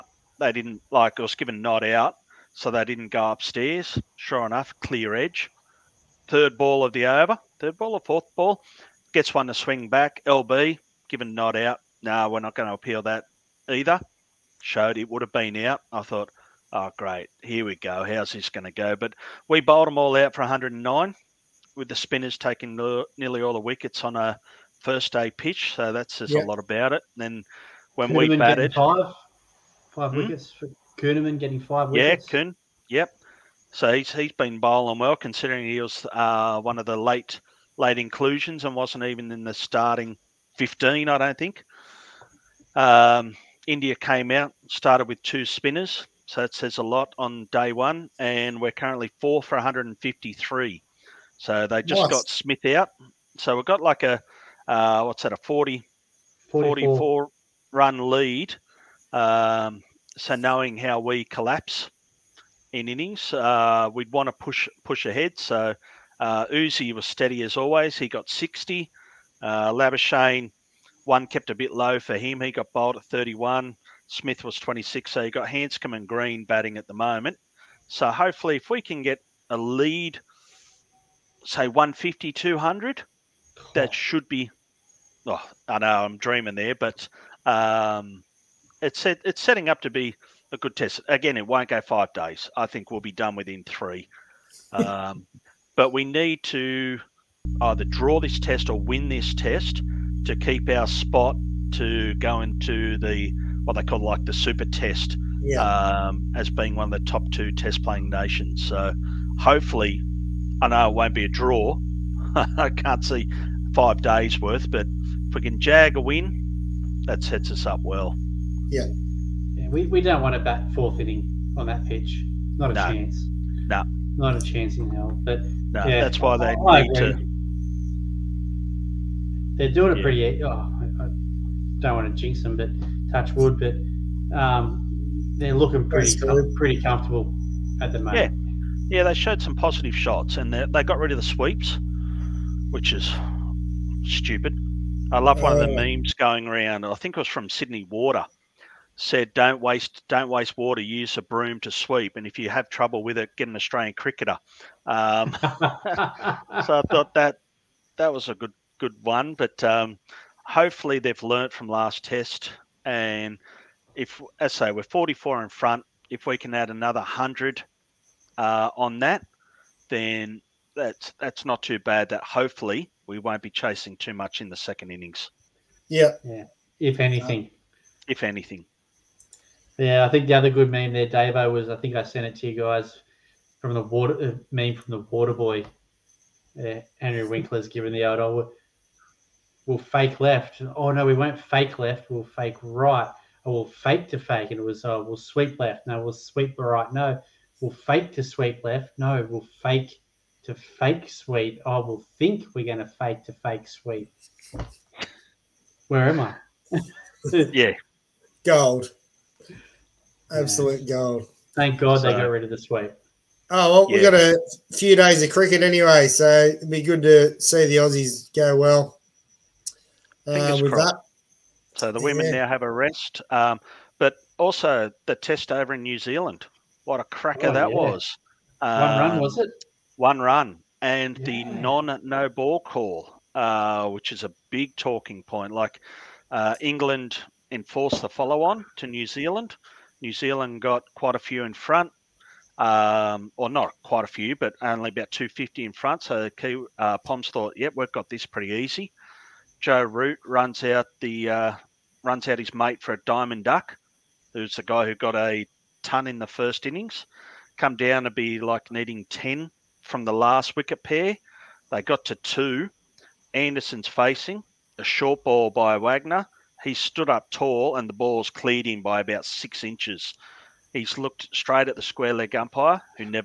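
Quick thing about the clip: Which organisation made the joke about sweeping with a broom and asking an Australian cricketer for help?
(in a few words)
Sydney Water.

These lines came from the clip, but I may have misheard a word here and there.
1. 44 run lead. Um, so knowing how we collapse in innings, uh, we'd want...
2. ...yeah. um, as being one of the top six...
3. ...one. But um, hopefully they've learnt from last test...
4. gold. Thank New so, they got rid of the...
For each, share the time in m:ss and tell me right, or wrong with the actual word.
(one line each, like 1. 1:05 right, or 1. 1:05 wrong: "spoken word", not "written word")
1. 0:56 right
2. 1:45 wrong: "two", not "six"
3. 2:39 right
4. 3:30 wrong: "God", not "New".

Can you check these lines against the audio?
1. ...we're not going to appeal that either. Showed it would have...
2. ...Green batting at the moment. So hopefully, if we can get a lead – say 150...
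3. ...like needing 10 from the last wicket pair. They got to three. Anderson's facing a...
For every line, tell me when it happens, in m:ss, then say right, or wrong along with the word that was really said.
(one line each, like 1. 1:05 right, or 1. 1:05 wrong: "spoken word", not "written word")
1. 0:12 right
2. 1:16 right
3. 4:18 wrong: "two", not "three".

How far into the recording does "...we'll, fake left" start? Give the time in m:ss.
3:09.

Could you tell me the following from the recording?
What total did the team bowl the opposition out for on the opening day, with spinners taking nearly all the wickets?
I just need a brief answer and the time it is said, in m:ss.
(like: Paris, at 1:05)
109, at 0:20.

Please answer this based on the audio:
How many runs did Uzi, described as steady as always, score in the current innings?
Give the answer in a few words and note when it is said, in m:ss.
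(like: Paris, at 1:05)
60, at 1:08.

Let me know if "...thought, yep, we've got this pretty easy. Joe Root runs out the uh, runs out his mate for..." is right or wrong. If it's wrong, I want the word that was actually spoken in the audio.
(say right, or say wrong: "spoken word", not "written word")
right.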